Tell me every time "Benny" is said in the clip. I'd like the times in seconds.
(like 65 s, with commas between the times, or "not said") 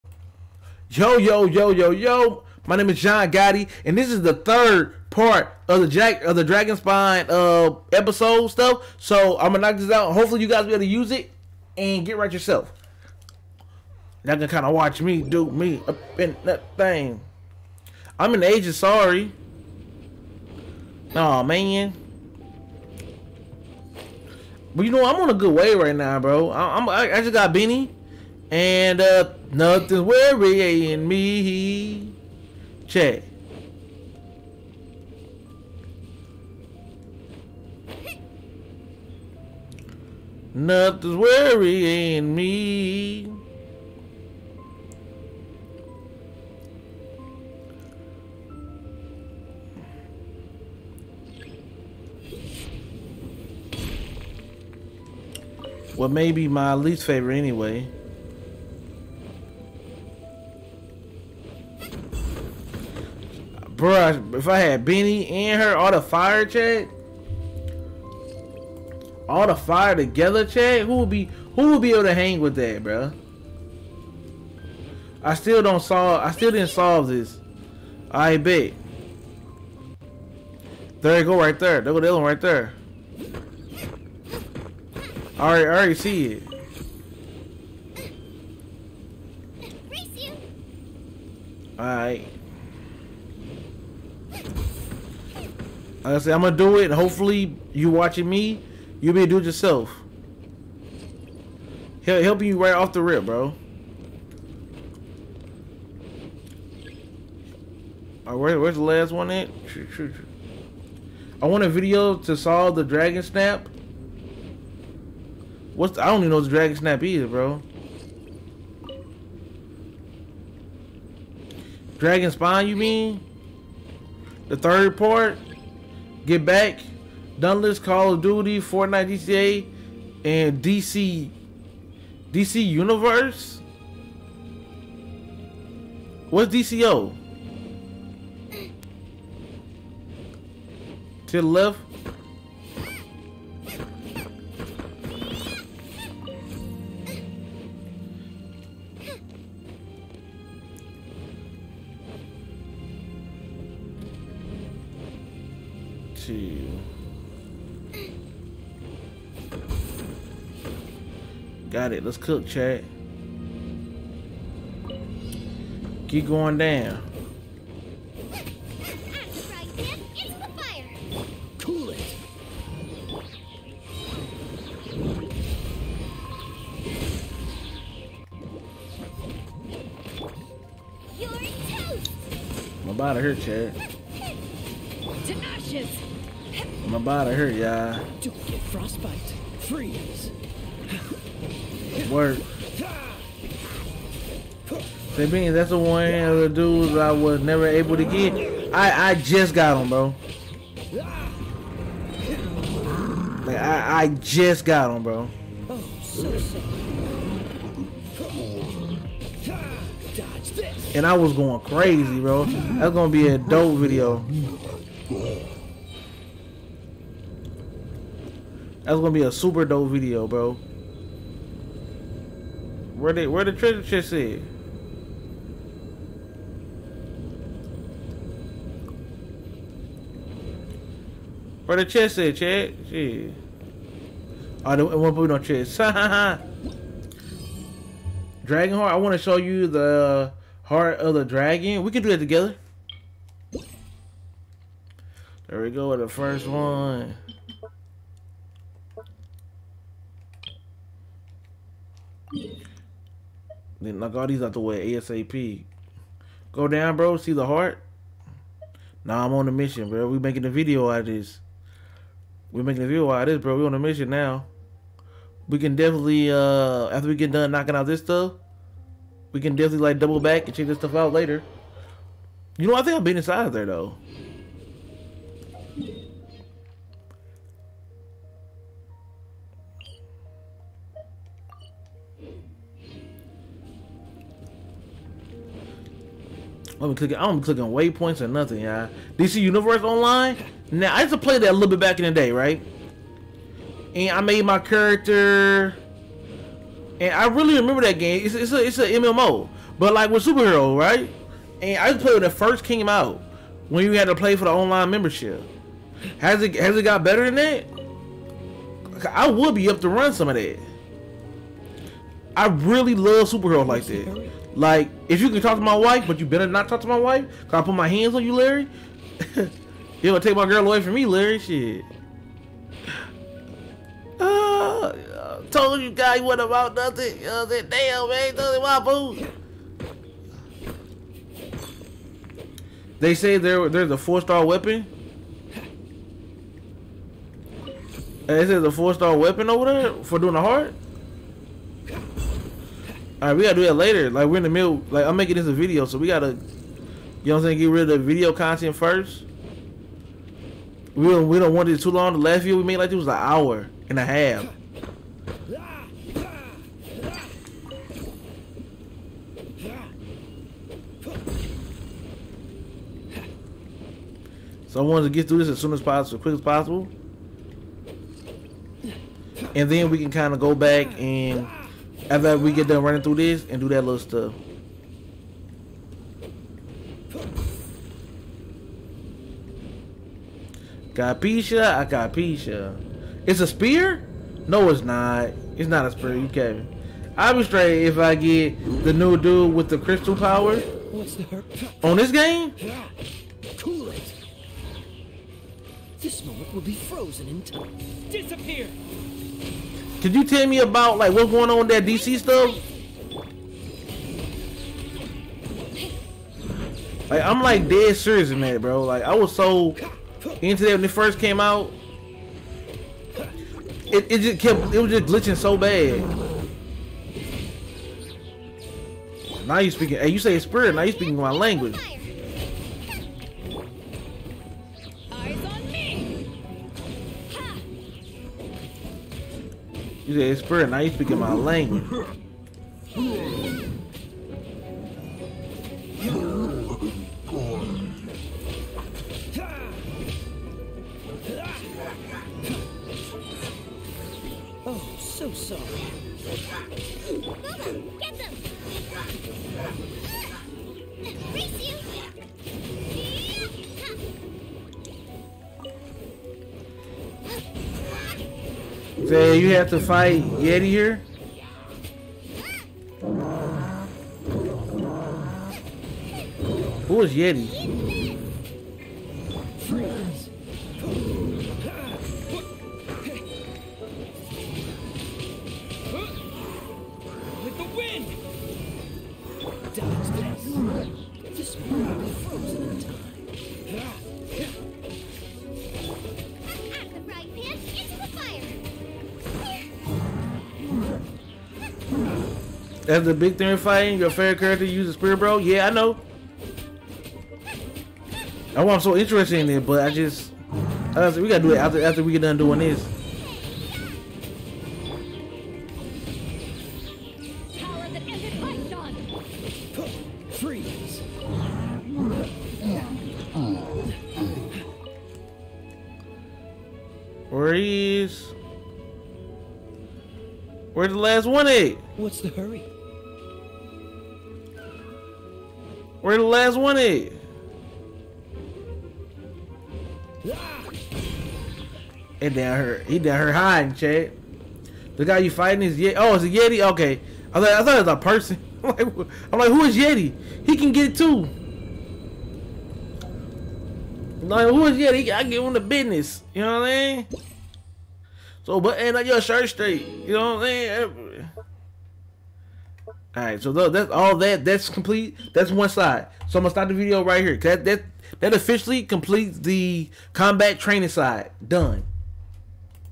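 27 s, 64 s.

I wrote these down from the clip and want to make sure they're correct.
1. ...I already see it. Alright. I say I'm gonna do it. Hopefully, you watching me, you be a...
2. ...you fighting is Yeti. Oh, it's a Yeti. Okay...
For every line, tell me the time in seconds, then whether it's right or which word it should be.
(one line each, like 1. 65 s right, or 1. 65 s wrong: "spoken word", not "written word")
1. 85 s right
2. 535 s right.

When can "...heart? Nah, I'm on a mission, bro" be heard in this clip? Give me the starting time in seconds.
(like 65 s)
257 s.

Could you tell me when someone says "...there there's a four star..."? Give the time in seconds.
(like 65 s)
333 s.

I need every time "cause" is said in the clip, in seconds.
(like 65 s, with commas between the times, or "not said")
317 s.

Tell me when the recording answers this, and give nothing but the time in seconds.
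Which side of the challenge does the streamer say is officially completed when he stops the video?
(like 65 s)
560 s.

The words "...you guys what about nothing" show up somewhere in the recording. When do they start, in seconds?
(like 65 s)
325 s.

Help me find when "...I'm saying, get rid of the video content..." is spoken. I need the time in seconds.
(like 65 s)
347 s.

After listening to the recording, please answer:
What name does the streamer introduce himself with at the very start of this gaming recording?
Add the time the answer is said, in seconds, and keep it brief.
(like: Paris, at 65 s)
John Gotti, at 2 s.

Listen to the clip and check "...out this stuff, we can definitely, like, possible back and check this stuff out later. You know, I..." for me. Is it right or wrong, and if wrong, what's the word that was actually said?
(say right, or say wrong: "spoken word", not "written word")
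wrong: "double", not "possible".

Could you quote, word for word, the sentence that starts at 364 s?
So I wanted to get through this as soon as possible, as quick as possible.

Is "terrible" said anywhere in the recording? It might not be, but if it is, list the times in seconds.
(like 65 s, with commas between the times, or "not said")
not said.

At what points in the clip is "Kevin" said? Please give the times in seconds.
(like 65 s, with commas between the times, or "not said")
386 s.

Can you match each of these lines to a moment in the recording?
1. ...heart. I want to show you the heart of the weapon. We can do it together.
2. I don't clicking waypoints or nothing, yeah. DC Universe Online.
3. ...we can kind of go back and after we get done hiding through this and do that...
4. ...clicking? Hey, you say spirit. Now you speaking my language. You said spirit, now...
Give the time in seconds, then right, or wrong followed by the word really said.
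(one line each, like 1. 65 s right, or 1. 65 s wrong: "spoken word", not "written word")
1. 238 s wrong: "dragon", not "weapon"
2. 287 s right
3. 369 s wrong: "running", not "hiding"
4. 419 s wrong: "speaking", not "clicking".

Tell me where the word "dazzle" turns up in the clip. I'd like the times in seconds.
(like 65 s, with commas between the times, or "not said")
not said.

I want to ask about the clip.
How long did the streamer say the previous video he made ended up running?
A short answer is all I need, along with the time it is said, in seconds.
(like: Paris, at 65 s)
an hour and a half, at 353 s.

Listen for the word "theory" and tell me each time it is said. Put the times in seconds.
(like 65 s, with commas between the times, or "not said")
493 s.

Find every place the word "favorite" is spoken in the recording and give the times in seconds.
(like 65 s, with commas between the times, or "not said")
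57 s, 494 s.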